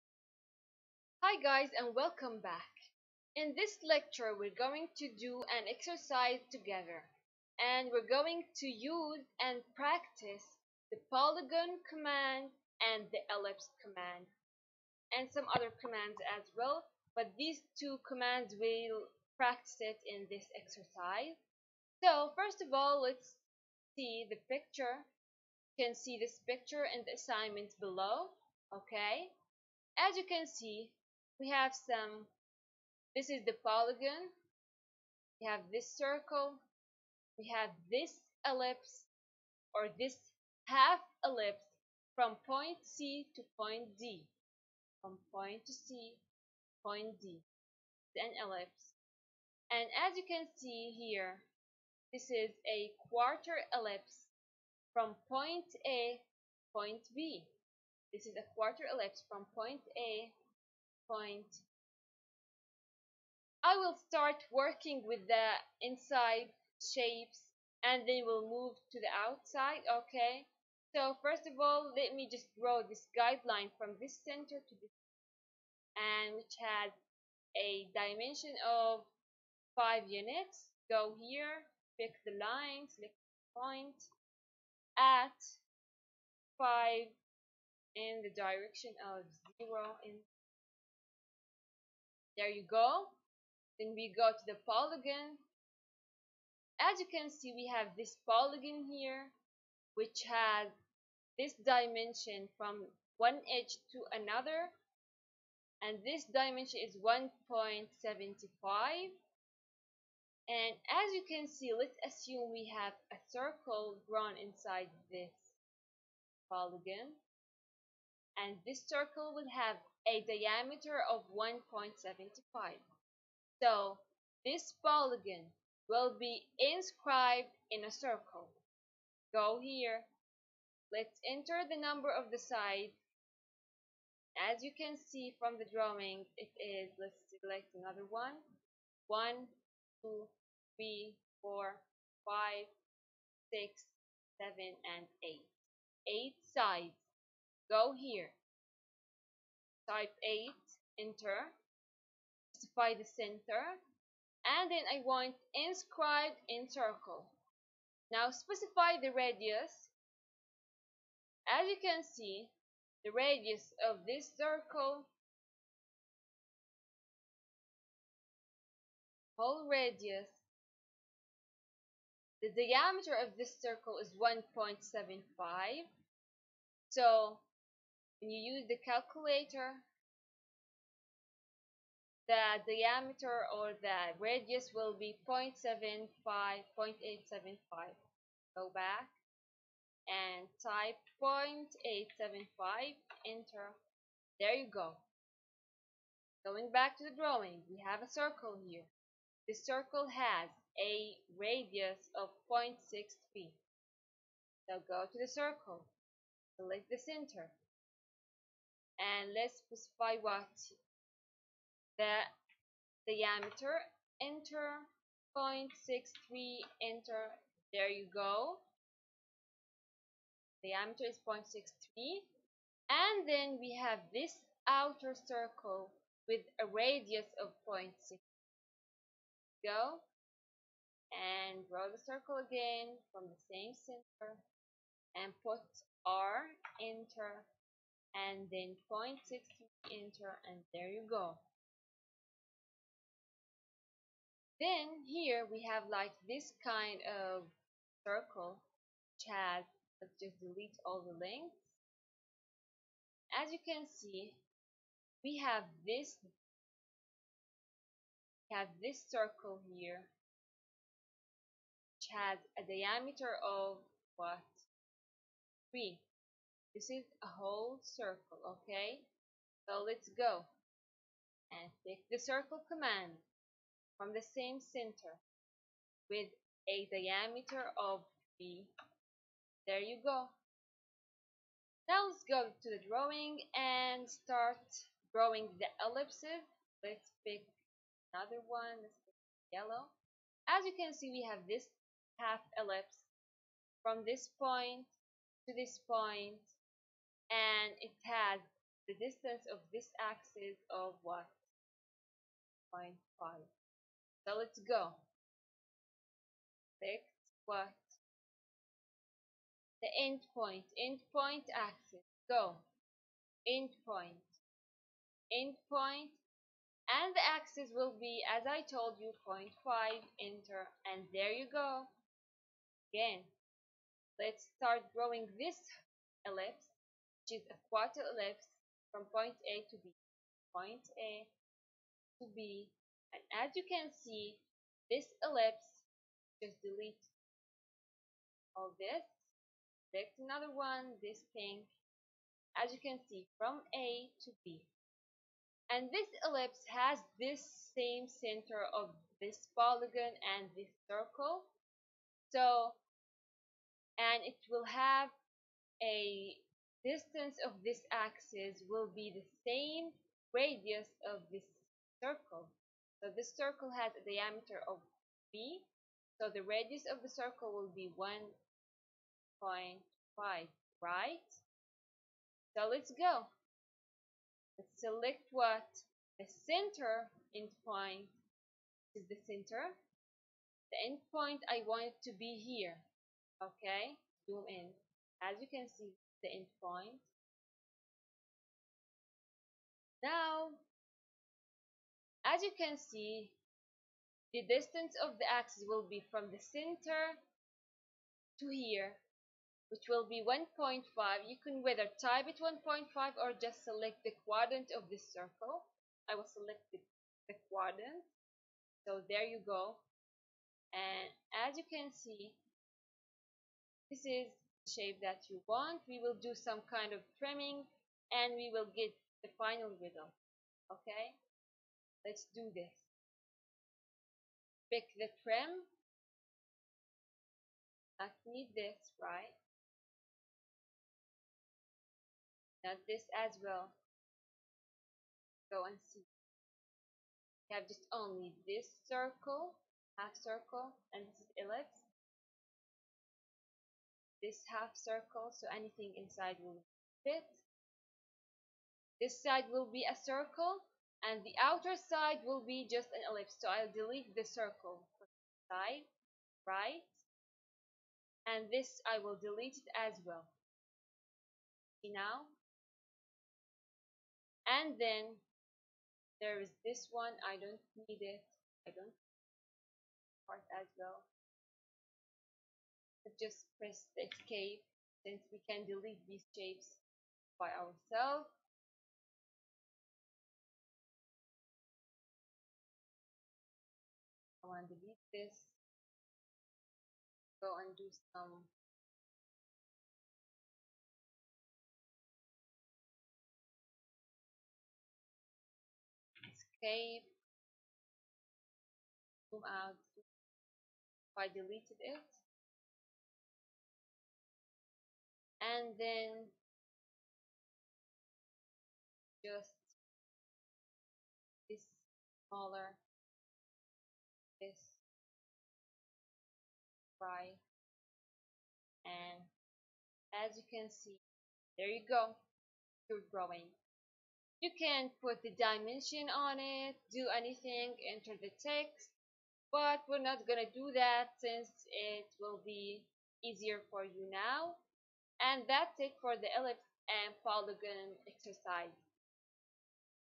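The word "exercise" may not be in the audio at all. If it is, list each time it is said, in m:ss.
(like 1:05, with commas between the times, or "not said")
0:05, 0:20, 8:58.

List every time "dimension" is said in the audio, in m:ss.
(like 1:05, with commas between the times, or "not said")
1:17, 1:41, 1:46, 8:45.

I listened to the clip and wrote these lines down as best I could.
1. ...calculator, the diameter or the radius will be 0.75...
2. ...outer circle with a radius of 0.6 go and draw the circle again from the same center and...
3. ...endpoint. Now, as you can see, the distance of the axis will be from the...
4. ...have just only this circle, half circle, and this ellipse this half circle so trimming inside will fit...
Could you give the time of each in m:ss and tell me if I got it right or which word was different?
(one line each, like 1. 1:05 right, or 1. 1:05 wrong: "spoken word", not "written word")
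1. 2:58 right
2. 3:44 right
3. 6:26 right
4. 7:17 wrong: "anything", not "trimming".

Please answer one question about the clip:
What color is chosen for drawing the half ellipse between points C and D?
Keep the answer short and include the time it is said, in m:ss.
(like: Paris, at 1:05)
yellow, at 4:48.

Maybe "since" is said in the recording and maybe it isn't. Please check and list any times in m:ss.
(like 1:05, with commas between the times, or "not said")
7:55, 8:51.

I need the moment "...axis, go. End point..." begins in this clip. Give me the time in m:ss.
5:11.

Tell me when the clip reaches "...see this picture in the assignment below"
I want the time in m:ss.
0:25.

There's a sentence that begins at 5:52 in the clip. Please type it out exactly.
So, and it will have a distance of this axis will be the same radius of this circle.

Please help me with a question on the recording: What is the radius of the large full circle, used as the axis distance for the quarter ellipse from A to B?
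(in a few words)
1.5.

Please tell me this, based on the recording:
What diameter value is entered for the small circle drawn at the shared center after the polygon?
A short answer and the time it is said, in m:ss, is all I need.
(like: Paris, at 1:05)
0.63, at 3:35.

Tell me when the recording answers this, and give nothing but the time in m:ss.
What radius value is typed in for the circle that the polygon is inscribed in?
3:10.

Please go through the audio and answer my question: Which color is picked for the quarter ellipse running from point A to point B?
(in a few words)
pink.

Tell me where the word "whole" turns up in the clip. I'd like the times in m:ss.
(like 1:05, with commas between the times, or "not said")
2:49, 4:27.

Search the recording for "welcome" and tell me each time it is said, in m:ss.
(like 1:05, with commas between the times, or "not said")
0:01.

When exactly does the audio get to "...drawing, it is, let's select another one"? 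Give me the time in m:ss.
2:15.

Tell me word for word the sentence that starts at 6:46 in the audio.
I will select the, the quadrant.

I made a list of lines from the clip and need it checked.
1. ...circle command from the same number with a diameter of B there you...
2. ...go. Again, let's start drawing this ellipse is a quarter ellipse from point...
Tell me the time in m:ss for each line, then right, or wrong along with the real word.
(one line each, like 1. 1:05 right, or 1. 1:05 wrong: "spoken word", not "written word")
1. 4:32 wrong: "center", not "number"
2. 5:21 right.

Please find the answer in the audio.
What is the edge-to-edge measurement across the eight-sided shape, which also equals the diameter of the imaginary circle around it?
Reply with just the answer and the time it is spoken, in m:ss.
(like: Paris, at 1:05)
1.75, at 1:46.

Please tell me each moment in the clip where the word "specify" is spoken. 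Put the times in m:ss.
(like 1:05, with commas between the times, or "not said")
2:32, 2:38, 3:29.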